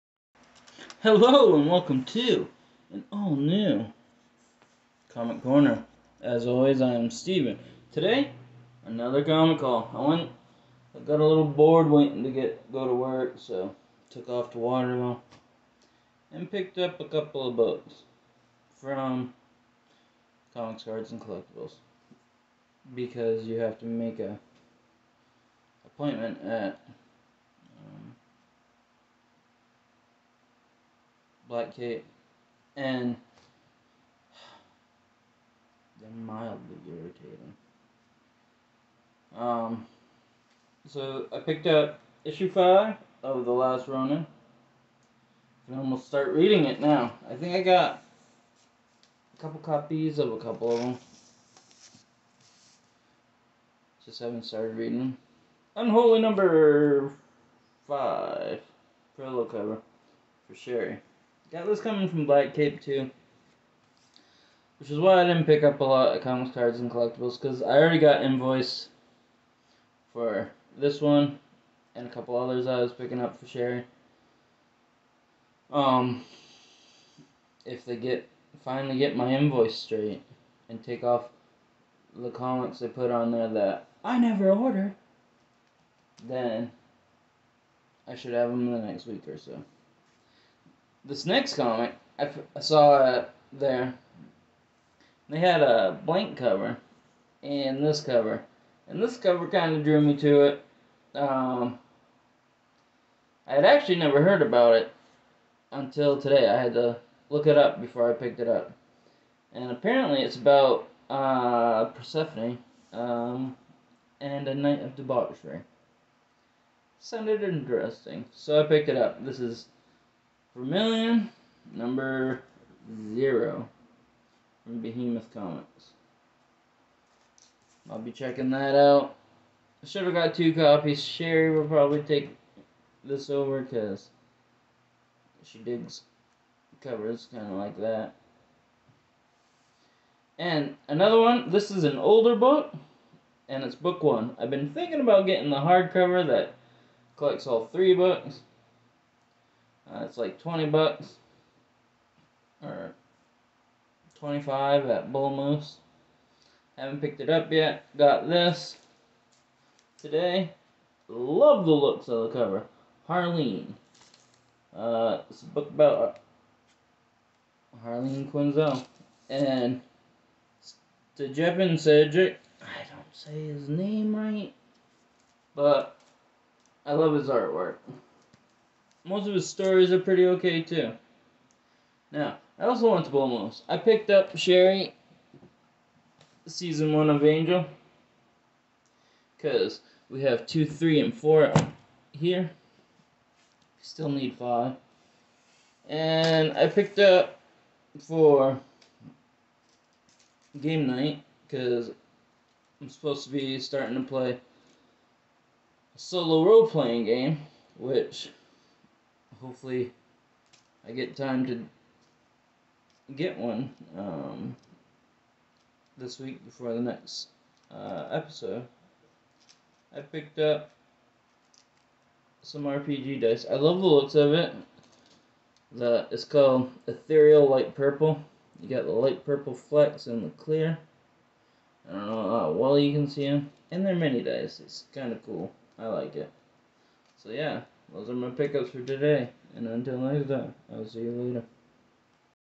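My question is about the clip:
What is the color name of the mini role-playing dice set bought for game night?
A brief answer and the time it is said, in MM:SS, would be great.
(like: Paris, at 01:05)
Ethereal Light Purple, at 03:46.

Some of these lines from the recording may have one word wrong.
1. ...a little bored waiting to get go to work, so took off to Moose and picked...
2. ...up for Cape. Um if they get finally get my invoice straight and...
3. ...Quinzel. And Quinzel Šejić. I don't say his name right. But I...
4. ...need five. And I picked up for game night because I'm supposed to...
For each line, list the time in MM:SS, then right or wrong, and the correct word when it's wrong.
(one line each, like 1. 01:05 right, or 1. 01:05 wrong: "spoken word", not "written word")
1. 00:11 wrong: "Waterville", not "Moose"
2. 01:13 wrong: "Sherry", not "Cape"
3. 02:48 wrong: "Stjepan", not "Quinzel"
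4. 03:14 right.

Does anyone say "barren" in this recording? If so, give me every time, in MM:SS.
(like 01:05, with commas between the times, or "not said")
not said.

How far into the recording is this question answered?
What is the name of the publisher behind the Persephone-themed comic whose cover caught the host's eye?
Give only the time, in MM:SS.
02:04.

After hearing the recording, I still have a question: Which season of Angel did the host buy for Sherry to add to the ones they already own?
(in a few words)
season one.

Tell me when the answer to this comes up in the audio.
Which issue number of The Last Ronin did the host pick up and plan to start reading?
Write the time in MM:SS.
00:42.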